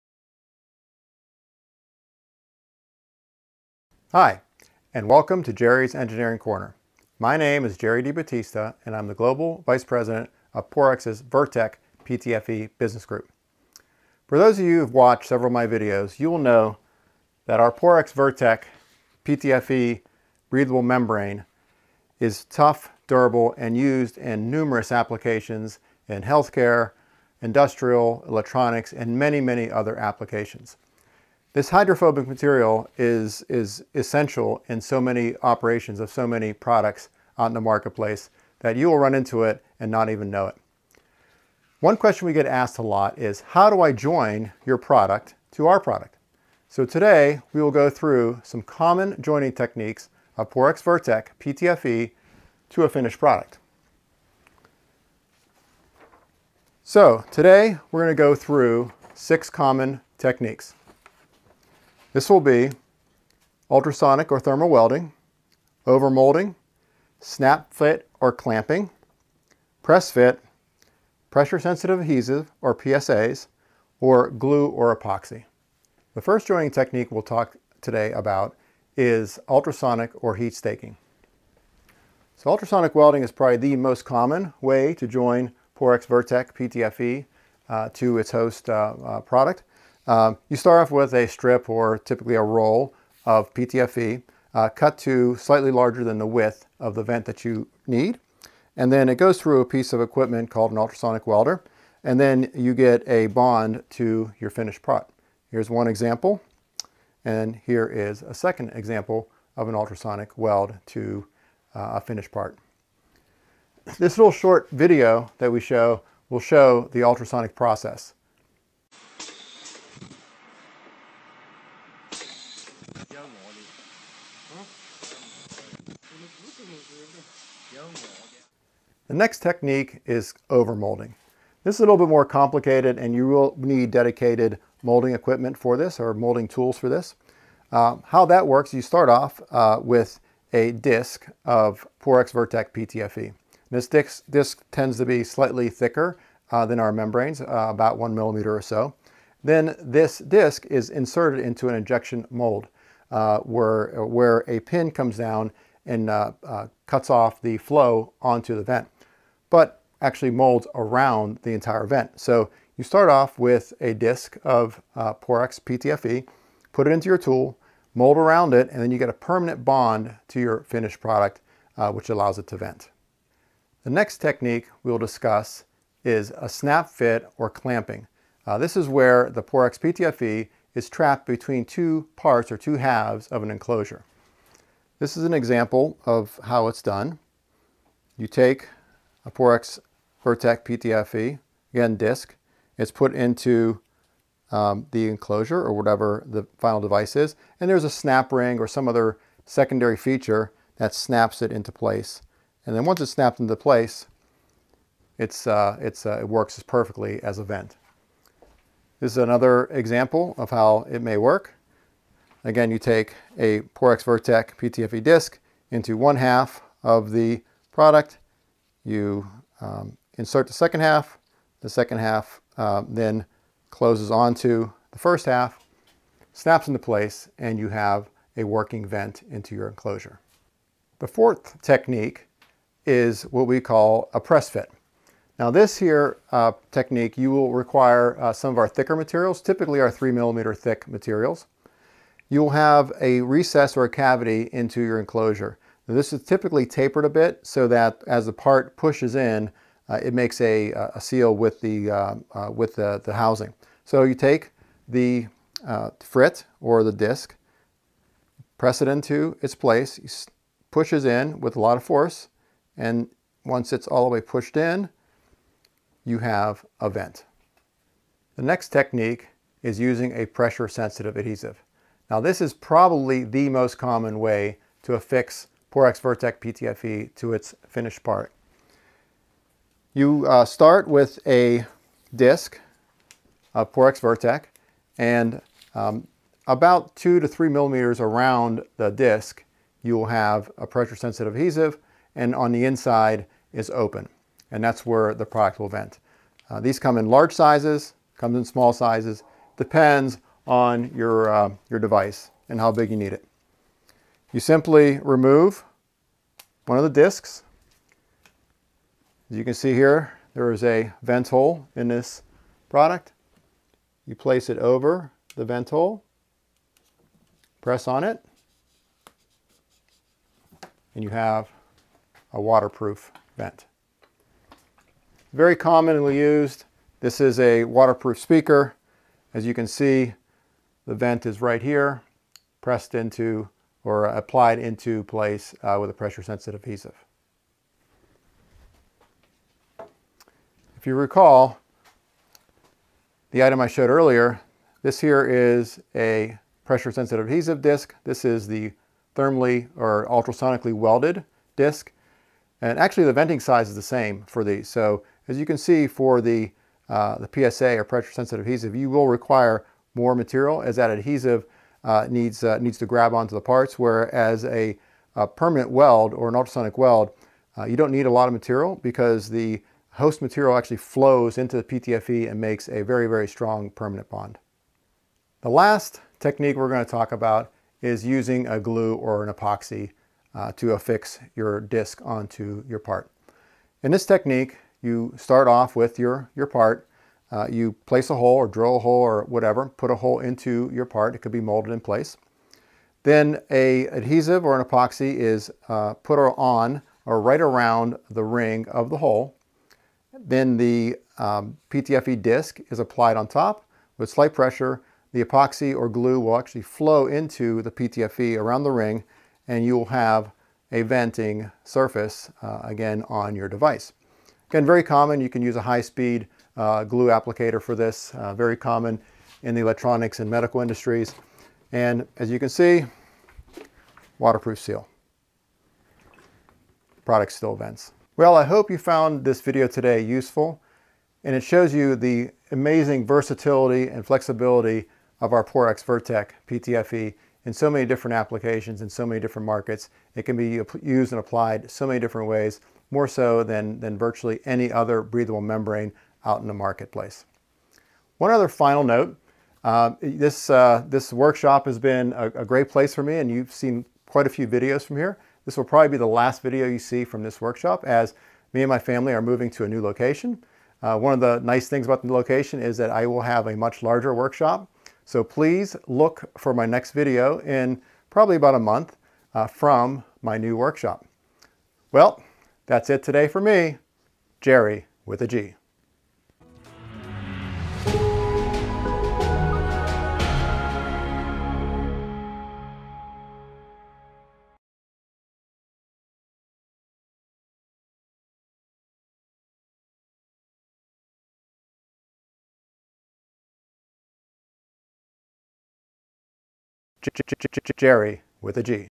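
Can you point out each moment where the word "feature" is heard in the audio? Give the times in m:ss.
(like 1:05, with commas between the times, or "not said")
3:19.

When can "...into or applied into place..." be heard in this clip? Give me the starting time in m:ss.
5:32.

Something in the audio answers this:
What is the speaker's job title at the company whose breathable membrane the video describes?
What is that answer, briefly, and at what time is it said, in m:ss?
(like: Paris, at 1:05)
Global Vice President, at 0:09.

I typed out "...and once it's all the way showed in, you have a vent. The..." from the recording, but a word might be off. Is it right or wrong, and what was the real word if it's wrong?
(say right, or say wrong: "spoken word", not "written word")
wrong: "pushed", not "showed".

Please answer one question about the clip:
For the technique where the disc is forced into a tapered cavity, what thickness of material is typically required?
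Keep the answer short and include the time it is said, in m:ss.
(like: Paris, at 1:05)
3 millimeters, at 3:59.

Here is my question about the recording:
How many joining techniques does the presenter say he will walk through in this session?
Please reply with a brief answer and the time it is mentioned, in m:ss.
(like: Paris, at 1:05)
6, at 0:59.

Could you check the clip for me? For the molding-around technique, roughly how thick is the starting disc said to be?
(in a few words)
About 1 millimeter.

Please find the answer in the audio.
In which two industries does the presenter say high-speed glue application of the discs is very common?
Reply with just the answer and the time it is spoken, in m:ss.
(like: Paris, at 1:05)
Electronics and medical, at 6:59.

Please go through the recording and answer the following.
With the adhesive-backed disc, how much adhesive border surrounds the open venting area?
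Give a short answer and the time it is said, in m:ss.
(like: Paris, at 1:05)
2 to 3 millimeters, at 4:46.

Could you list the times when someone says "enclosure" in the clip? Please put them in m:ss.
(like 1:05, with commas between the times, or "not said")
3:03, 3:15, 3:49, 4:05.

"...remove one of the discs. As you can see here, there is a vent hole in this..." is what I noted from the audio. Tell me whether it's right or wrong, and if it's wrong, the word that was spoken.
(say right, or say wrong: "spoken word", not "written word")
right.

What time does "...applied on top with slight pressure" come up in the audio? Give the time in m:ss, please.
6:42.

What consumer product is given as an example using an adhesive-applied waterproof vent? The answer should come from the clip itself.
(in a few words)
Waterproof speaker.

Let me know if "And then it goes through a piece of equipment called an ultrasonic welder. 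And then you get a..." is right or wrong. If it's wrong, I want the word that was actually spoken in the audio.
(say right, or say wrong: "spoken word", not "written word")
right.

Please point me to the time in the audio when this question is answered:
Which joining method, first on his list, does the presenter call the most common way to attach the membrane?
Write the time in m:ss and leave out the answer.
1:22.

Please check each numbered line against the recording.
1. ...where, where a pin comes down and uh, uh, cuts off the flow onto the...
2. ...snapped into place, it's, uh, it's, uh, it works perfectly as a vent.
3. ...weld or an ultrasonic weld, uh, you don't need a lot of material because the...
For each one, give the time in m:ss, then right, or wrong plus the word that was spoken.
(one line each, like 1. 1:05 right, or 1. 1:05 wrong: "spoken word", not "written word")
1. 2:33 right
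2. 3:23 right
3. 6:05 right.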